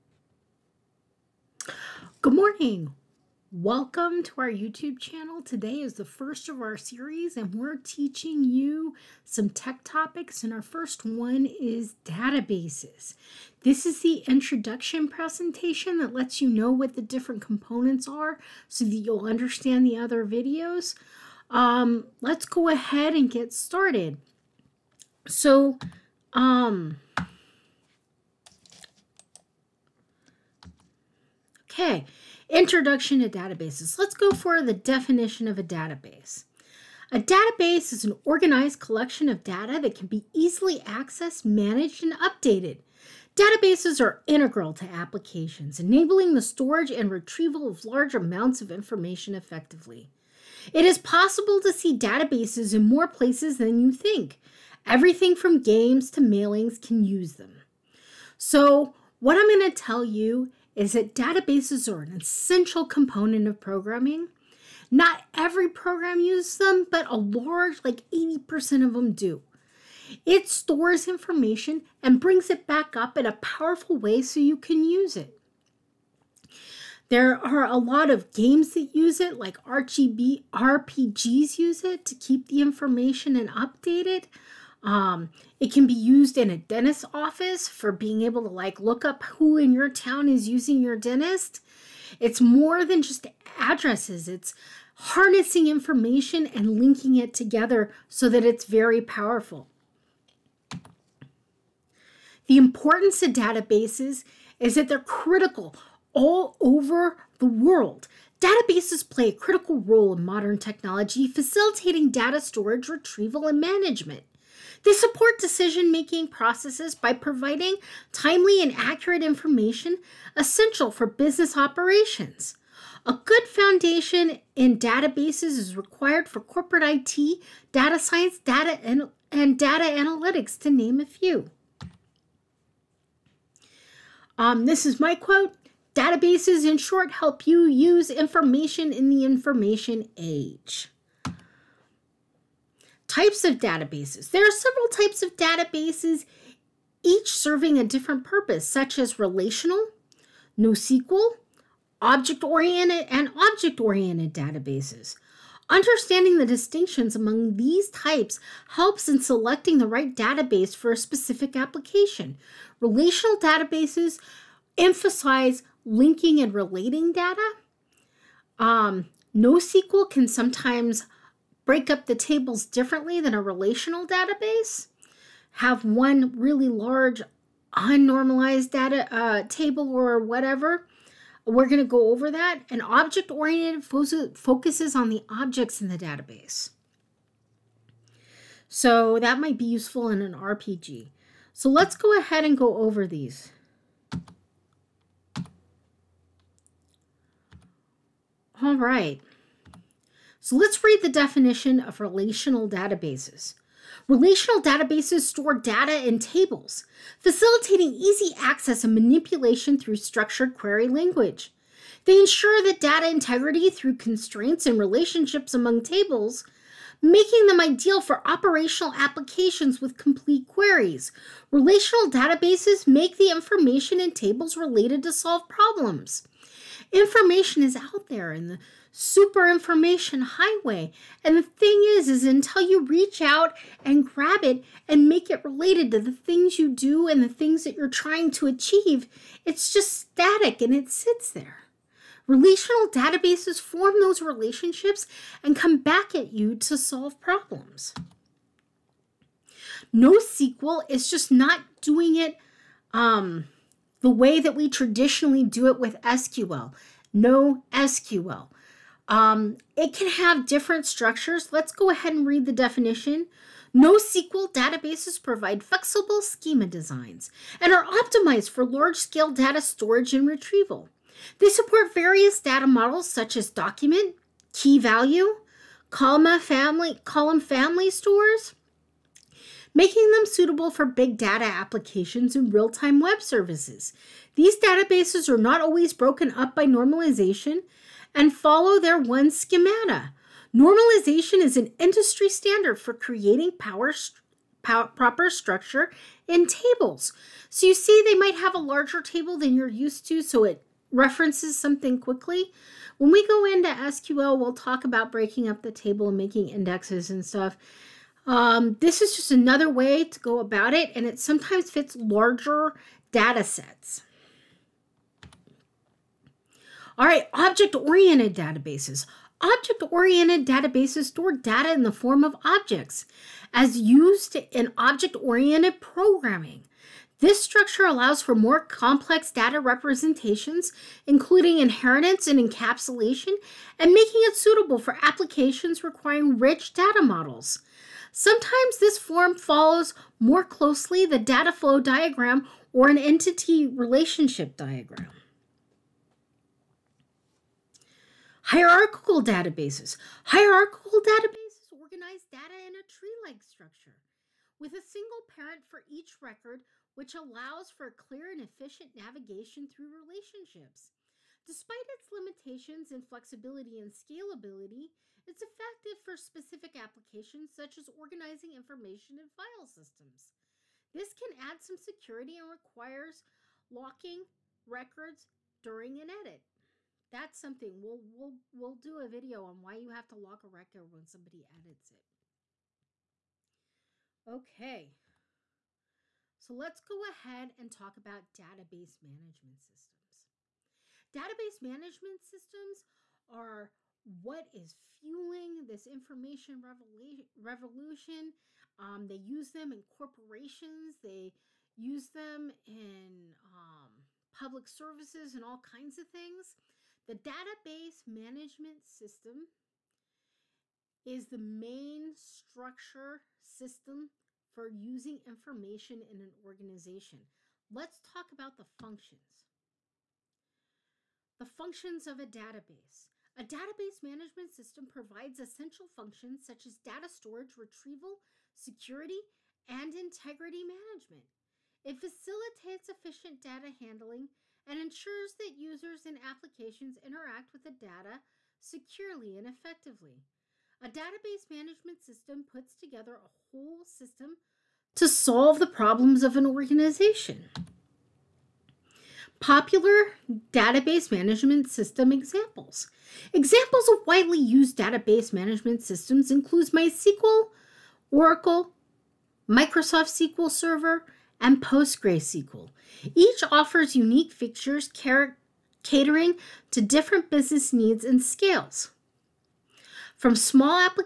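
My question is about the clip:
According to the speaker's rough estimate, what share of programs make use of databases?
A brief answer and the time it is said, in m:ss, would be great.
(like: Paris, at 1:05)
80%, at 1:08.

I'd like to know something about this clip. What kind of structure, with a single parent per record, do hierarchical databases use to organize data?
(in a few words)
Tree-like structure.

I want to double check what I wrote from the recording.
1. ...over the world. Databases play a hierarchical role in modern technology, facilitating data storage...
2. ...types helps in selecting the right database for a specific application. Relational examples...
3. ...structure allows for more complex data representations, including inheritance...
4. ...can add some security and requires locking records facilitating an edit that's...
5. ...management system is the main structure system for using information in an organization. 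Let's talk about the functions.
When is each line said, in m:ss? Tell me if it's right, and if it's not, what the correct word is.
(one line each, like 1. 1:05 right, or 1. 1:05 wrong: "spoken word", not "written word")
1. 1:46 wrong: "critical", not "hierarchical"
2. 2:37 wrong: "databases", not "examples"
3. 5:27 right
4. 6:11 wrong: "during", not "facilitating"
5. 6:48 right.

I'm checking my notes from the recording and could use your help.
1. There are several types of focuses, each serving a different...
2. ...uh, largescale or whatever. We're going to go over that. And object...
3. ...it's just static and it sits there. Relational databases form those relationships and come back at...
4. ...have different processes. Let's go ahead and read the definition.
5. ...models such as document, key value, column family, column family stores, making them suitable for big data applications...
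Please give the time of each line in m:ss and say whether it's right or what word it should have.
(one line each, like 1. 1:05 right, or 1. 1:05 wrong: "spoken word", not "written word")
1. 2:24 wrong: "databases", not "focuses"
2. 2:59 wrong: "table", not "largescale"
3. 3:59 right
4. 4:20 wrong: "structures", not "processes"
5. 4:32 right.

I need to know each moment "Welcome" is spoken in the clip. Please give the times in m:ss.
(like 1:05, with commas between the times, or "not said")
0:03.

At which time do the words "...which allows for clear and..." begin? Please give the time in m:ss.
5:56.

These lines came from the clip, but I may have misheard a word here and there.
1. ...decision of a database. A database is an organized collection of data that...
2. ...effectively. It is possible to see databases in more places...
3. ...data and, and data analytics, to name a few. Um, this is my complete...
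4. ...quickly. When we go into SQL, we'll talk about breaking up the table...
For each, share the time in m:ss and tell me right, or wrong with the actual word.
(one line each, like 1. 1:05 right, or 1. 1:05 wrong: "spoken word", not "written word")
1. 0:34 wrong: "definition", not "decision"
2. 0:49 right
3. 2:08 wrong: "quote", not "complete"
4. 5:01 right.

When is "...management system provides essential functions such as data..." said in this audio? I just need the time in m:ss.
7:04.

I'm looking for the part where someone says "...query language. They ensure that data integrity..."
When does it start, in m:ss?
3:30.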